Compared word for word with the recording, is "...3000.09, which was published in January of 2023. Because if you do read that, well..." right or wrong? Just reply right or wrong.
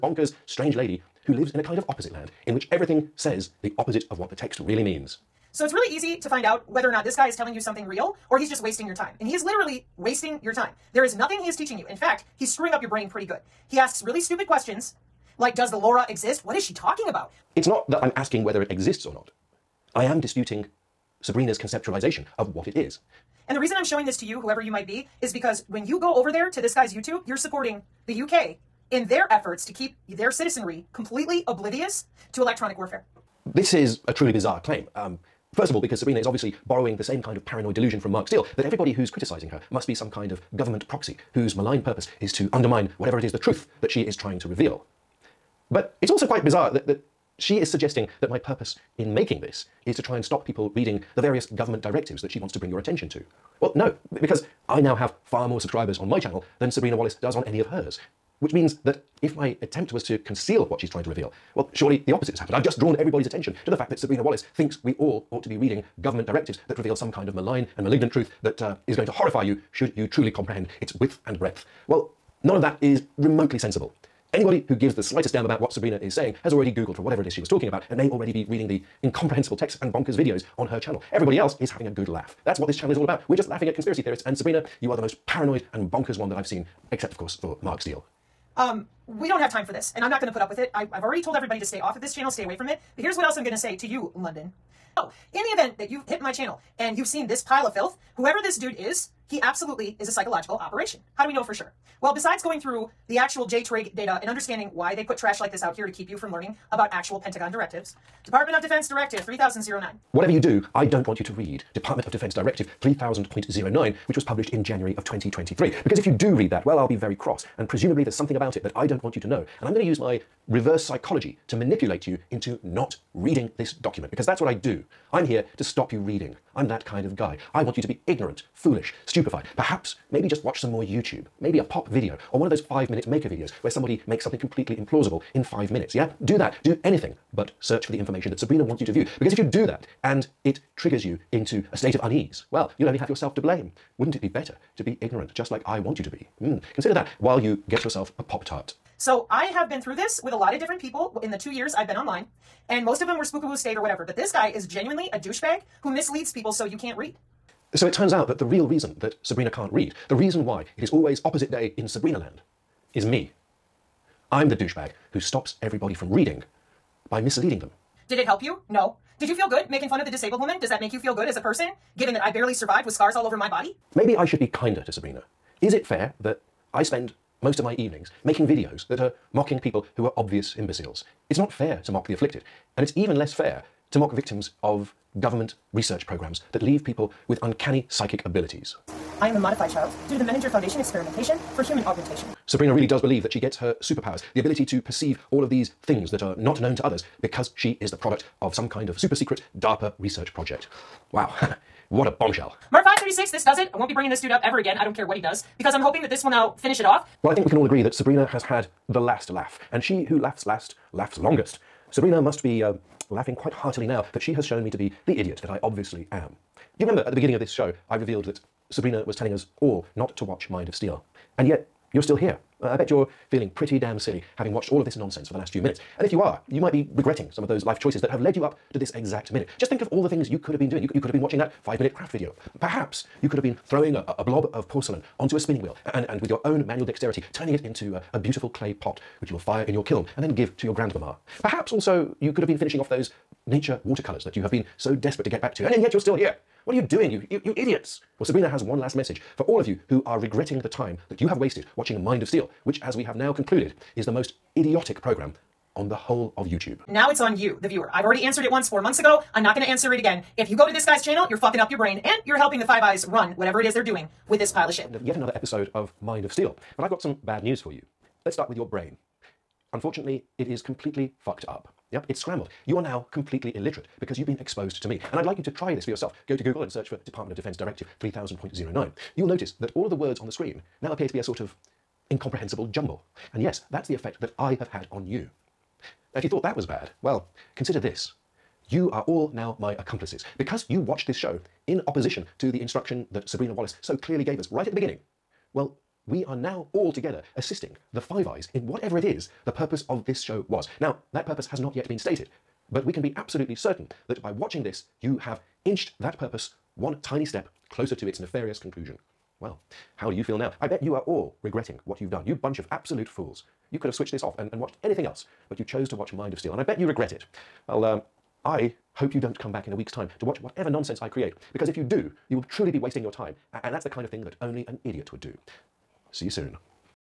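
right.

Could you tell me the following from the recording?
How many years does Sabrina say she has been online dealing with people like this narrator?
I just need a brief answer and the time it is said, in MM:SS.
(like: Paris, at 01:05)
2, at 02:31.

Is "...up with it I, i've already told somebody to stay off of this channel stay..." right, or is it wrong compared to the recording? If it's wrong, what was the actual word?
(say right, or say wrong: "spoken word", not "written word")
wrong: "everybody", not "somebody".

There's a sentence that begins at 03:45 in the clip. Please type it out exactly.
And if you are, you might be regretting some of those life choices that have led you up to this exact minute.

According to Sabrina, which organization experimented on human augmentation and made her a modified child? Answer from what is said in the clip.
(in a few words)
Menninger Foundation.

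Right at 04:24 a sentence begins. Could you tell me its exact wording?
Uh, yet another episode of Mind of Steele.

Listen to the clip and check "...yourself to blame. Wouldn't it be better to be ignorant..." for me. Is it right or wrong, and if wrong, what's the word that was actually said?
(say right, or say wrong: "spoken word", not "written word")
right.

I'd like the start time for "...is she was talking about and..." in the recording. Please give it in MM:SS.
01:17.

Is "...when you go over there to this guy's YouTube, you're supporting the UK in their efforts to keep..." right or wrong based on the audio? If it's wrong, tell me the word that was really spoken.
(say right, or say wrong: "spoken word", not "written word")
right.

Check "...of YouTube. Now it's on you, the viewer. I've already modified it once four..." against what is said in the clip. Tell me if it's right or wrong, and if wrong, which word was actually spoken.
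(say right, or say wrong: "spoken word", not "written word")
wrong: "answered", not "modified".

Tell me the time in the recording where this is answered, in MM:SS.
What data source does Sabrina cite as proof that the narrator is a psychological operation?
01:43.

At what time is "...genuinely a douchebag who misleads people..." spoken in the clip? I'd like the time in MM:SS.
02:34.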